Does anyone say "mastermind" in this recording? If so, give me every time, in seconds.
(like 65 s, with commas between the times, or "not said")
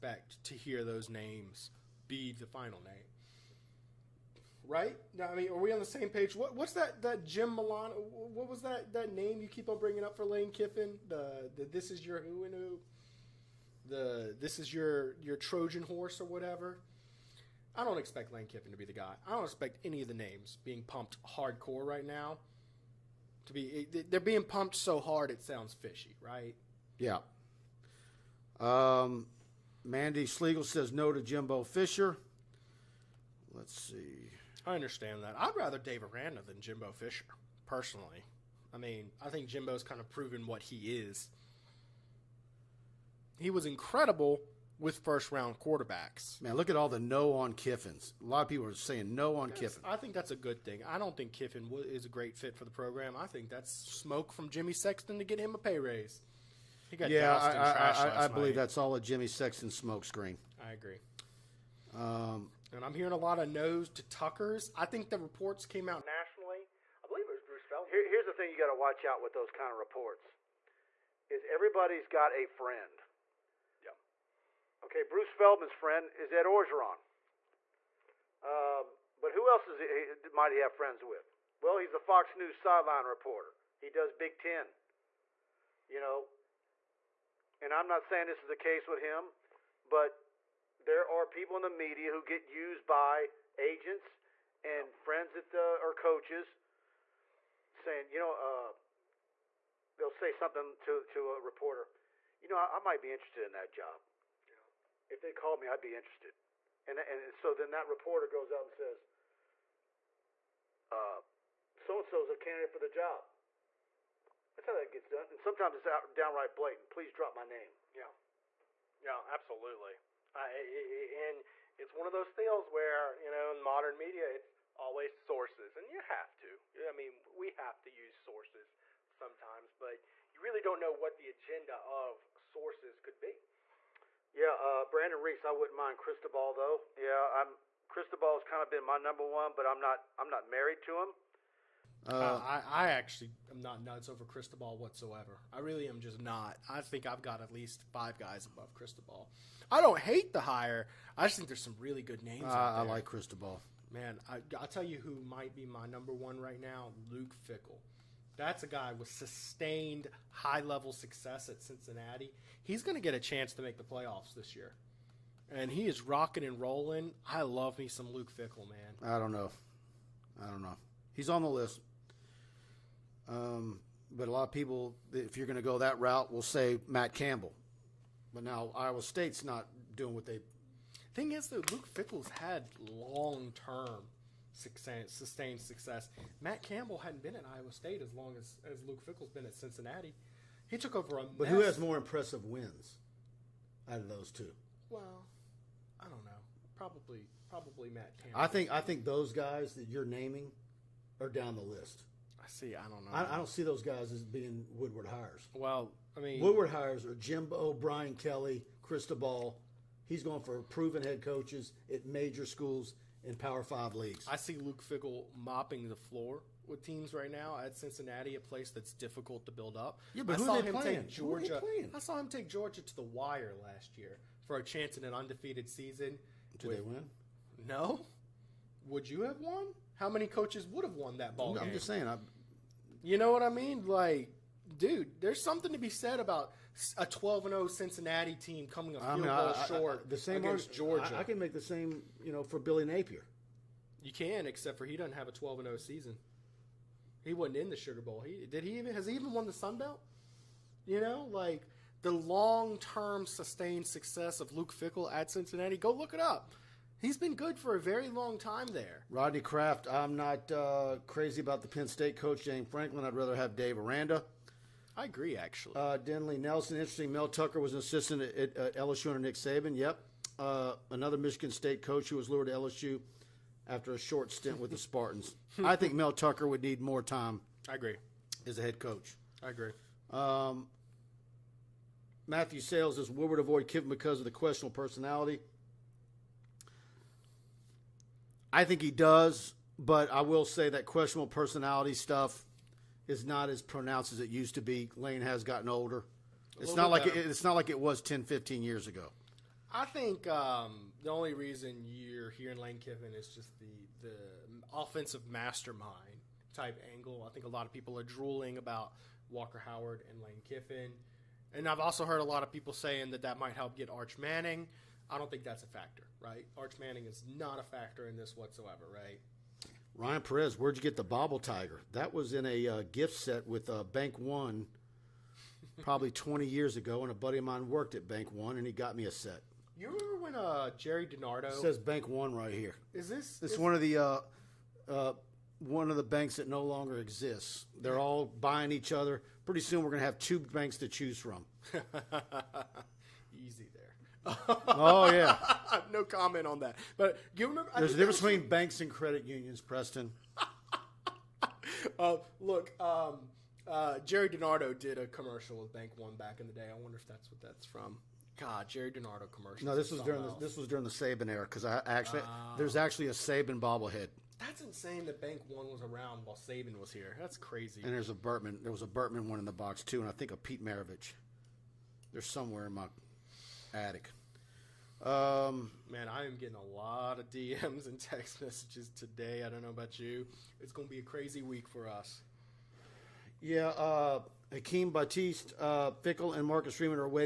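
305 s.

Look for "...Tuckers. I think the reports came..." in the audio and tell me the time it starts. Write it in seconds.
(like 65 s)
64 s.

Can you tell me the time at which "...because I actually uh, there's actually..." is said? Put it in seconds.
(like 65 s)
361 s.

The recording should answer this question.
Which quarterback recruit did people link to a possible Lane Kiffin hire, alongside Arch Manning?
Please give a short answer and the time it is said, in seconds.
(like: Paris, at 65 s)
Walker Howard, at 309 s.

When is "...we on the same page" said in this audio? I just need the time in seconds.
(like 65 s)
5 s.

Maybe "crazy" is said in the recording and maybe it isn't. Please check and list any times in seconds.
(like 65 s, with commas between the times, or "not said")
261 s, 367 s, 381 s.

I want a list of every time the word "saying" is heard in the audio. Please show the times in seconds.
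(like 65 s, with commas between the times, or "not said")
48 s, 88 s, 97 s, 231 s, 312 s.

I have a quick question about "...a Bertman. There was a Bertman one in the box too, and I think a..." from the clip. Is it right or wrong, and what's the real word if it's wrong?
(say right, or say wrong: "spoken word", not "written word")
right.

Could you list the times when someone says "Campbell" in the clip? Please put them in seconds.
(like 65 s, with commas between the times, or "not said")
177 s, 186 s, 198 s.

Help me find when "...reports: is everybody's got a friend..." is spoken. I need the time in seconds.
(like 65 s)
69 s.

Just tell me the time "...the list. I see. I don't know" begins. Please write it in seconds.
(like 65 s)
201 s.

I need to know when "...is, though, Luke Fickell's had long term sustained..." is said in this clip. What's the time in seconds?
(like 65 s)
181 s.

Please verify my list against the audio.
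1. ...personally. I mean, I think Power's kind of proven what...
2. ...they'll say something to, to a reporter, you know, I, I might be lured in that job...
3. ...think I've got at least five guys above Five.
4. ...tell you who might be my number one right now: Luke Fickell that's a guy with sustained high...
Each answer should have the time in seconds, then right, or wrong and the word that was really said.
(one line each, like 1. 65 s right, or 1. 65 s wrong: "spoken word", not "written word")
1. 37 s wrong: "Jimbo", not "Power"
2. 99 s wrong: "interested", not "lured"
3. 146 s wrong: "Cristobal", not "Five"
4. 154 s right.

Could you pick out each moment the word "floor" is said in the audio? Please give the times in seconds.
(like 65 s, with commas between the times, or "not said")
215 s.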